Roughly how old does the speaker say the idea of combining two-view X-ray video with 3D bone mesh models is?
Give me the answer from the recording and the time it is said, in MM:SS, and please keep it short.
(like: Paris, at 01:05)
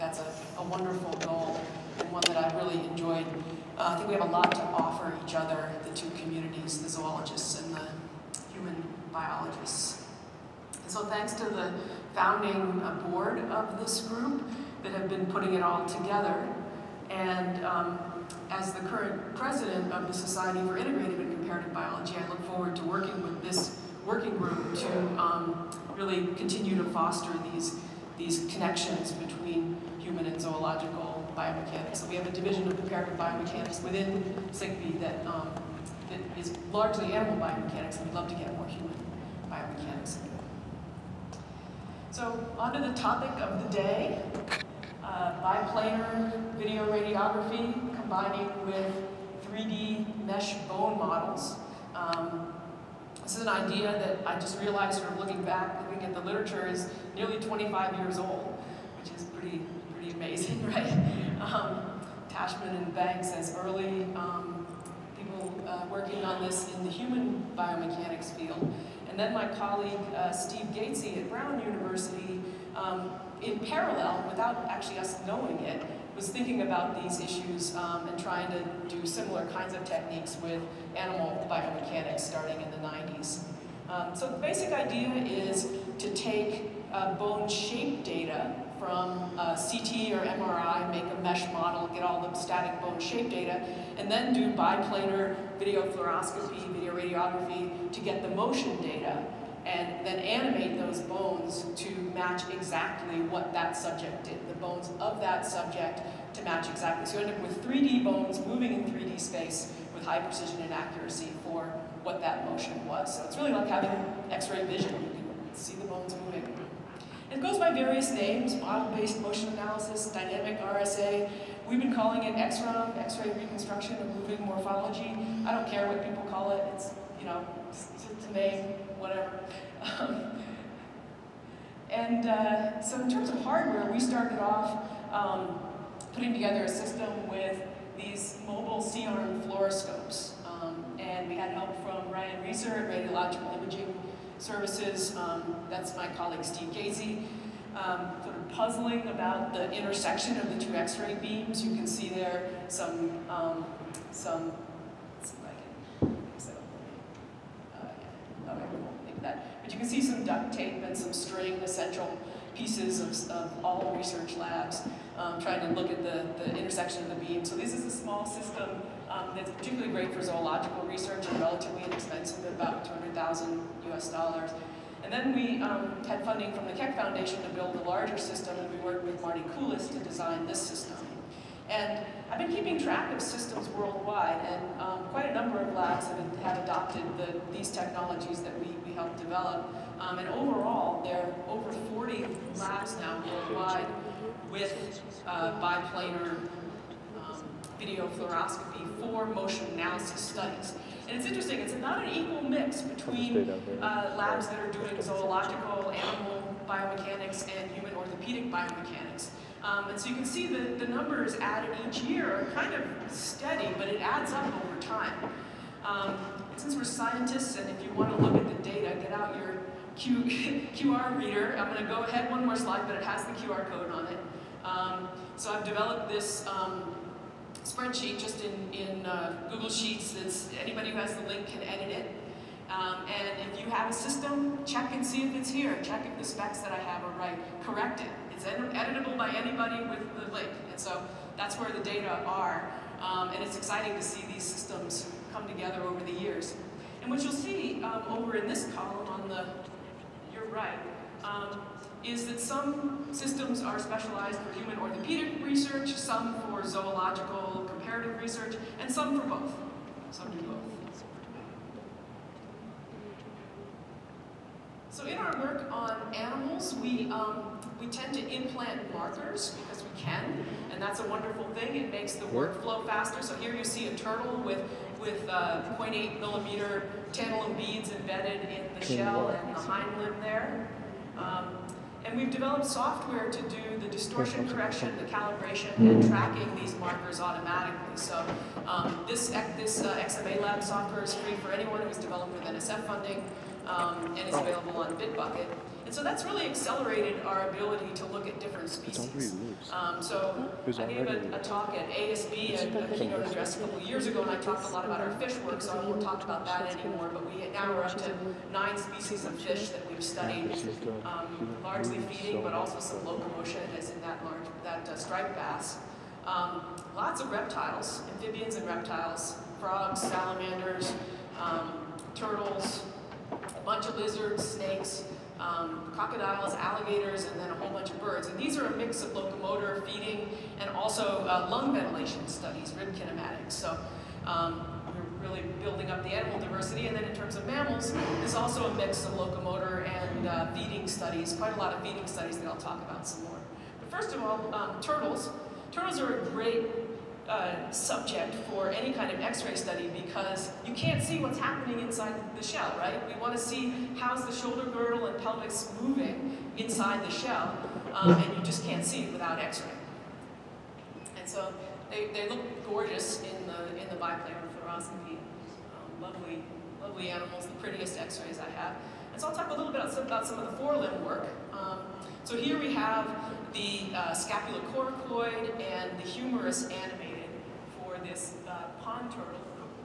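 nearly 25 years, at 00:57.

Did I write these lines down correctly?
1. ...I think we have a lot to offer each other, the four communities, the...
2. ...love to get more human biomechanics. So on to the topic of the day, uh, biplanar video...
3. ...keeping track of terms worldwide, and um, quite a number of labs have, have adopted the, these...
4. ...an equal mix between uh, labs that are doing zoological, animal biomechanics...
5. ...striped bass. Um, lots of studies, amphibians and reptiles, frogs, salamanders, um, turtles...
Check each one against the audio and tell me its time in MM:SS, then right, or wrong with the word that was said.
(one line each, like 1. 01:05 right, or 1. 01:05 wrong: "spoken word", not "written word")
1. 00:03 wrong: "two", not "four"
2. 00:38 right
3. 03:02 wrong: "systems", not "terms"
4. 03:22 right
5. 05:14 wrong: "reptiles", not "studies".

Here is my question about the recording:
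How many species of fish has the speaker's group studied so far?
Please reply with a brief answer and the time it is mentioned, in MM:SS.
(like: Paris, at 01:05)
9, at 05:08.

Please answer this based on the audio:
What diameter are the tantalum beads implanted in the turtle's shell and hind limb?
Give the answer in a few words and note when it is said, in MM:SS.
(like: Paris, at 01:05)
0.8 millimeter, at 04:35.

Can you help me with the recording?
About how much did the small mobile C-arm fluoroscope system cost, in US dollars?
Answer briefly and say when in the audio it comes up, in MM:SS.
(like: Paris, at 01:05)
200,000, at 02:52.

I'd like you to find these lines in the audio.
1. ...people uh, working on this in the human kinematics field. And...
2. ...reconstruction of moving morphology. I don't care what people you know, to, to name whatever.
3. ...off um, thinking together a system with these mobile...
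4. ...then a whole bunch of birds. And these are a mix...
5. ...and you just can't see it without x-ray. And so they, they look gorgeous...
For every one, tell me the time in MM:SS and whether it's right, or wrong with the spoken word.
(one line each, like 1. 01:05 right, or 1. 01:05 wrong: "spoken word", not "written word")
1. 01:05 wrong: "biomechanics", not "kinematics"
2. 02:03 right
3. 02:14 wrong: "putting", not "thinking"
4. 05:27 right
5. 05:58 right.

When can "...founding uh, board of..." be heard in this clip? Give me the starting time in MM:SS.
00:12.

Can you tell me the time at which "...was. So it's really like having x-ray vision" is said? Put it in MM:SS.
01:52.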